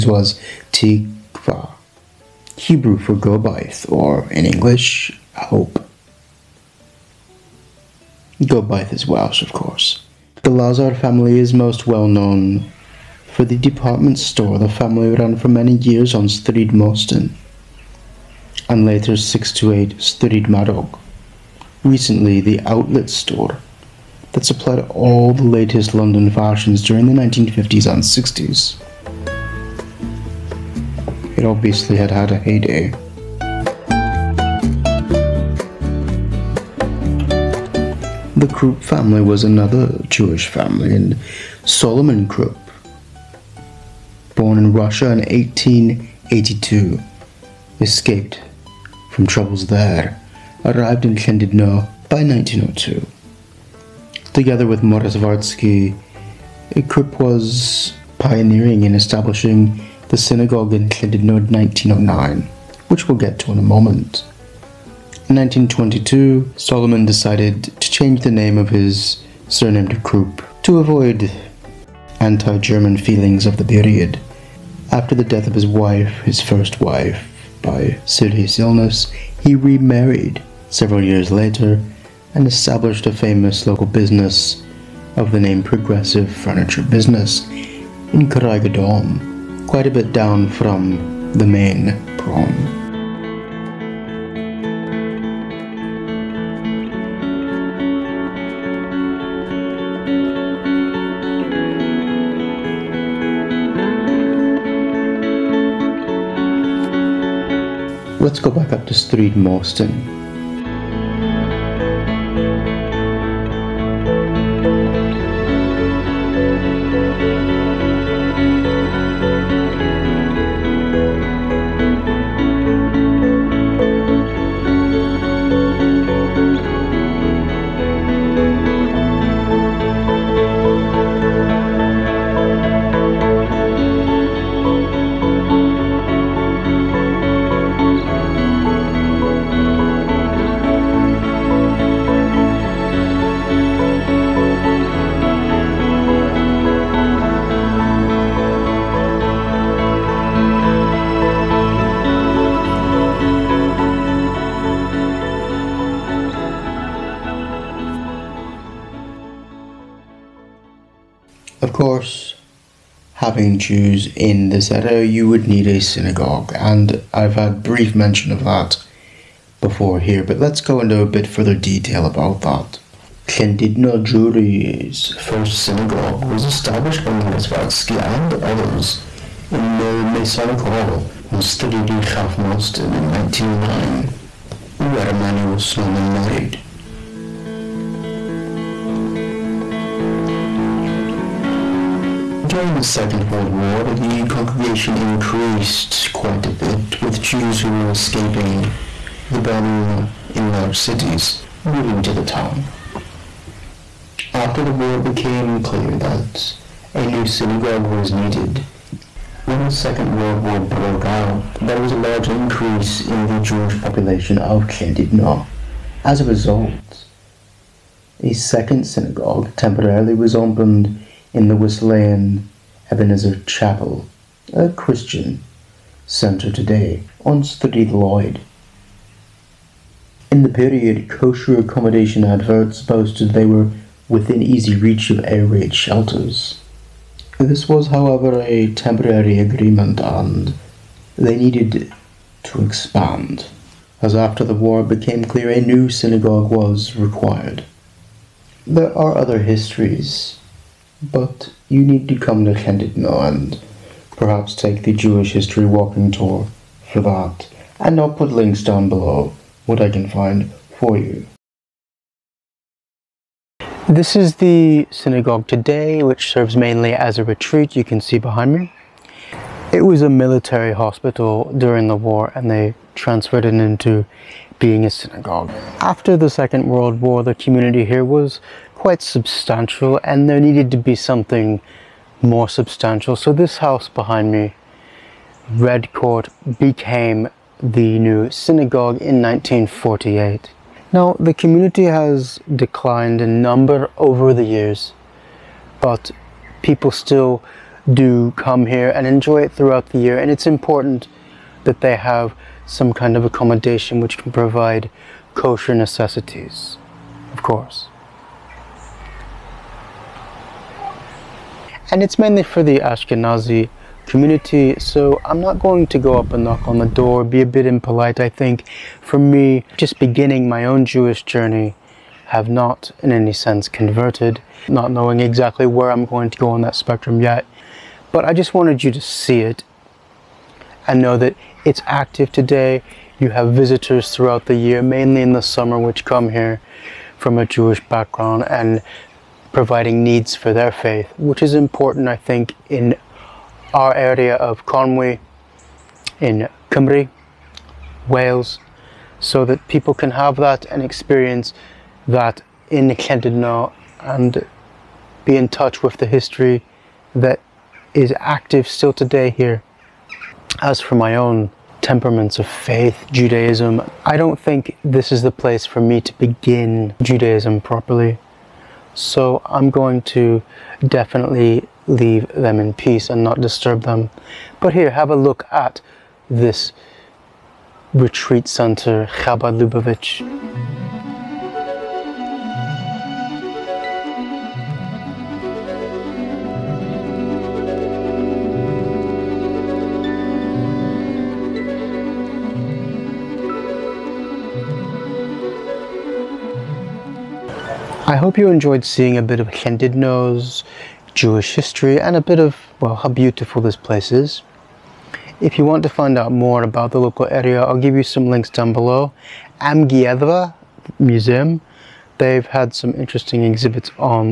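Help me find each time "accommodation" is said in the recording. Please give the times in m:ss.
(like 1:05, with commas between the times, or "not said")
3:51, 5:03.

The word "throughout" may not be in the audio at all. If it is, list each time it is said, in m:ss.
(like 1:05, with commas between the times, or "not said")
4:59, 5:34.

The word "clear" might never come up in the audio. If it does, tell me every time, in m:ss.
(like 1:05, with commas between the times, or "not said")
3:25, 4:05.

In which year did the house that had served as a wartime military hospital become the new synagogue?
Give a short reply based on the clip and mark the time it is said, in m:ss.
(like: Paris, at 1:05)
1948, at 4:49.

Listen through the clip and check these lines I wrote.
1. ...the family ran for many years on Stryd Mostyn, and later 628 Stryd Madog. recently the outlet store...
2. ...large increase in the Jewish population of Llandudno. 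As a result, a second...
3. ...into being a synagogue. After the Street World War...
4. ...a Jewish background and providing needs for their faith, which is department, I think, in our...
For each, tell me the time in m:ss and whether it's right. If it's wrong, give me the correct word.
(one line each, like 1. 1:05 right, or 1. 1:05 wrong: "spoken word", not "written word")
1. 0:14 right
2. 3:31 right
3. 4:33 wrong: "Second", not "Street"
4. 5:37 wrong: "important", not "department".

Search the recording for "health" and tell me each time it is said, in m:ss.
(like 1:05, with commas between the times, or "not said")
not said.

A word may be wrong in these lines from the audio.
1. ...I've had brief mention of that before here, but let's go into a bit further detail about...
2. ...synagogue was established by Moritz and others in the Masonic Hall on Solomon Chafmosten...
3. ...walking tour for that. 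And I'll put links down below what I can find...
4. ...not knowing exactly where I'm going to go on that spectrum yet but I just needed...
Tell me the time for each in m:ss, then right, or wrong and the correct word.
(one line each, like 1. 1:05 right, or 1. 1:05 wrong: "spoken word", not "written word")
1. 2:47 right
2. 2:55 wrong: "Stridi", not "Solomon"
3. 4:15 right
4. 5:24 wrong: "wanted", not "needed".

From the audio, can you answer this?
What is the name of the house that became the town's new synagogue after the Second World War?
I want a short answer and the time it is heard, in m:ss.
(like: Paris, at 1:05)
Red Court, at 4:45.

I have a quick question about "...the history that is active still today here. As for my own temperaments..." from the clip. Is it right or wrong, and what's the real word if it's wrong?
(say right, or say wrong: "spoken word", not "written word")
right.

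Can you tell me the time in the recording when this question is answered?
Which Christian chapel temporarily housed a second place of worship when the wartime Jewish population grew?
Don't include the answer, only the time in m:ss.
3:41.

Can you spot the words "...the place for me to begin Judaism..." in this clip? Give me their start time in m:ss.
6:05.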